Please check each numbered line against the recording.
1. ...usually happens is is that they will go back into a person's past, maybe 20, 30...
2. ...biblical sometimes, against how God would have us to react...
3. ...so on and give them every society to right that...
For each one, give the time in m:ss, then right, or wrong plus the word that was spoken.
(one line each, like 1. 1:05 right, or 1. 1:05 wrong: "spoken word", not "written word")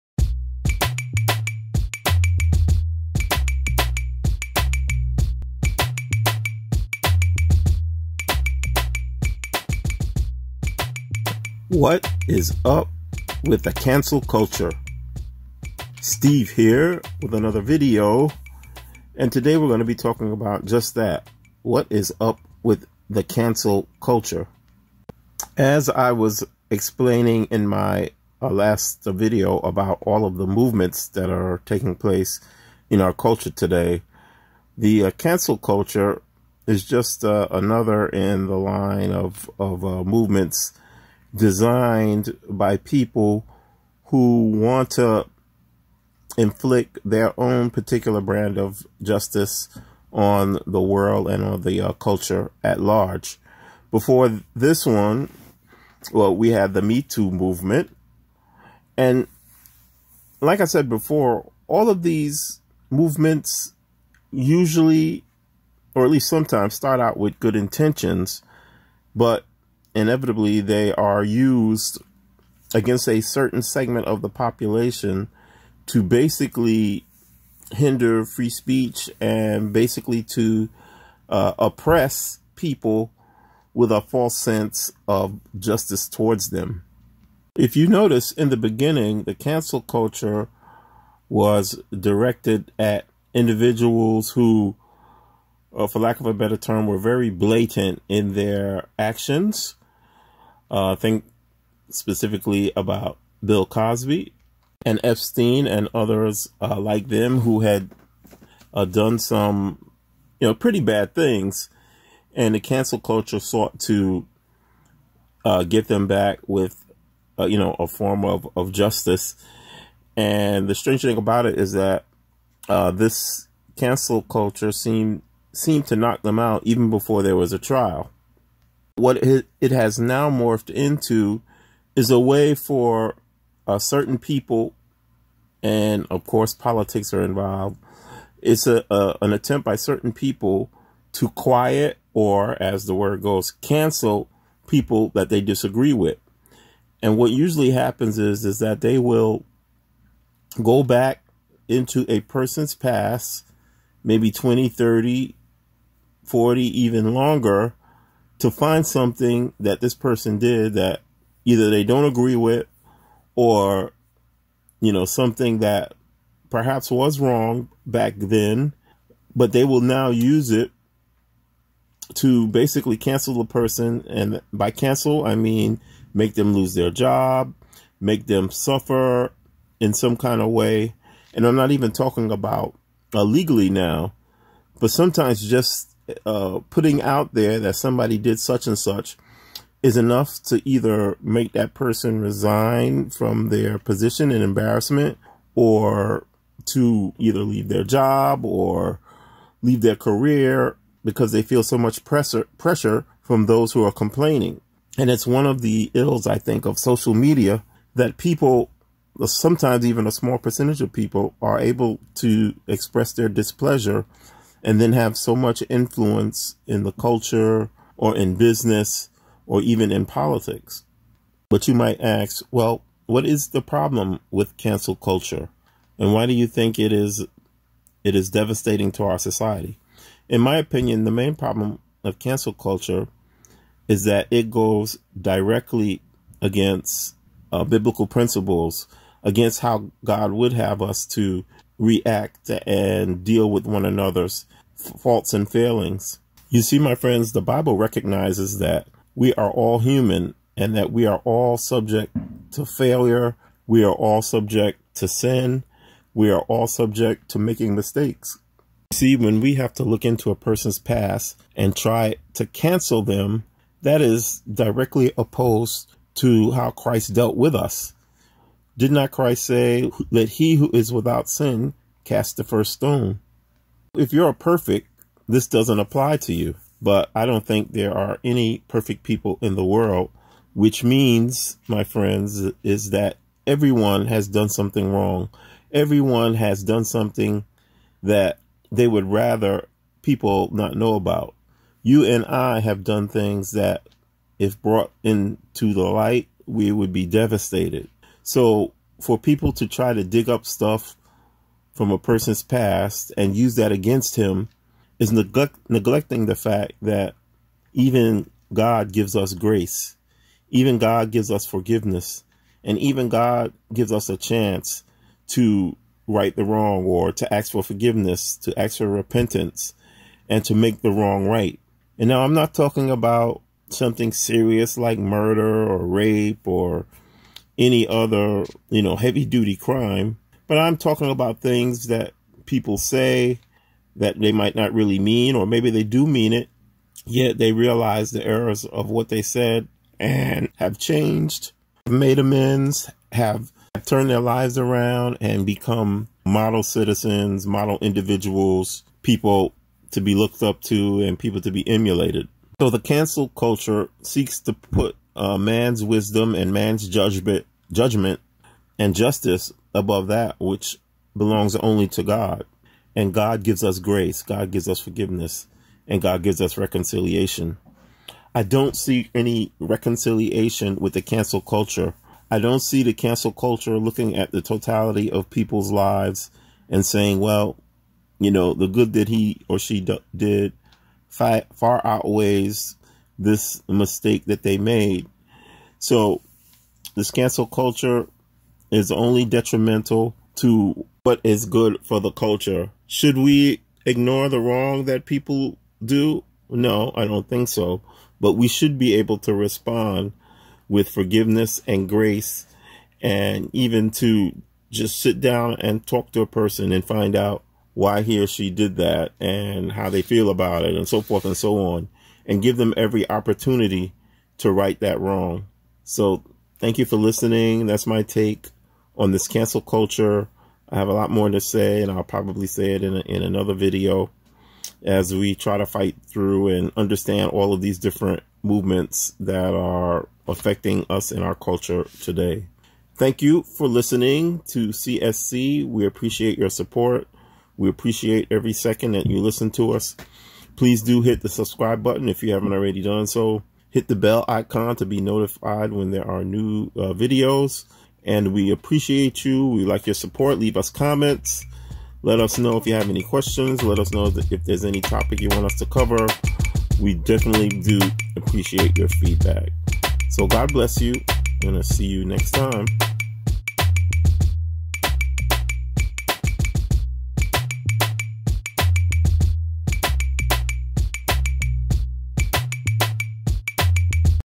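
1. 2:27 right
2. 3:57 wrong: "principles", not "sometimes"
3. 6:51 wrong: "opportunity", not "society".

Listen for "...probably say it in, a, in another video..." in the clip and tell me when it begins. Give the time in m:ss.
7:02.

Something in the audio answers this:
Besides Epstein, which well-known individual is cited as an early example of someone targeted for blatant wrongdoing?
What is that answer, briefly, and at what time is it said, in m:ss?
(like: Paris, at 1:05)
Bill Cosby, at 1:43.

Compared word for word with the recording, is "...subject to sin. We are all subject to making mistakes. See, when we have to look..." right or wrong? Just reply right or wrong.
right.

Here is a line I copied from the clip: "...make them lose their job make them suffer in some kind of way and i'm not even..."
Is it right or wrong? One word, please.
right.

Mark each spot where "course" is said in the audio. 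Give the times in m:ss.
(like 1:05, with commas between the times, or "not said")
2:16.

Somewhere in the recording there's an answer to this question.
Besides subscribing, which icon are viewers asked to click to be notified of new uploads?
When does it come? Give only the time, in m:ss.
7:23.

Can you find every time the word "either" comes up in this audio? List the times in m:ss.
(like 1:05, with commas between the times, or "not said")
2:41, 3:10, 3:17.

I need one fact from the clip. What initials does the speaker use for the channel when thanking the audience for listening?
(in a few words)
CSC.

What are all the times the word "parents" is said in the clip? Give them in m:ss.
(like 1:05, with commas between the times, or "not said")
not said.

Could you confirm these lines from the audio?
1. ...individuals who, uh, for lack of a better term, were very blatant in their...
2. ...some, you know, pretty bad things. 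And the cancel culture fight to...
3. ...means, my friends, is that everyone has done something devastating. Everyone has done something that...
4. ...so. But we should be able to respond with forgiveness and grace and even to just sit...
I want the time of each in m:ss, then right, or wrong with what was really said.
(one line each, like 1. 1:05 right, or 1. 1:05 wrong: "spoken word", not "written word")
1. 1:33 right
2. 1:49 wrong: "sought", not "fight"
3. 4:40 wrong: "wrong", not "devastating"
4. 6:37 right.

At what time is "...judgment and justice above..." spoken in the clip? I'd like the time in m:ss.
5:57.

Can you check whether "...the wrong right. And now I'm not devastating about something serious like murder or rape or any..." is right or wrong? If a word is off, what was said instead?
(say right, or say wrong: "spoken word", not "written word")
wrong: "talking", not "devastating".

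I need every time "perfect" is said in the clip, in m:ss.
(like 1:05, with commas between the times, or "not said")
4:34, 4:38.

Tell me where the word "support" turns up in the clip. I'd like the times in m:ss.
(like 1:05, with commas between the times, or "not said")
7:16, 7:29.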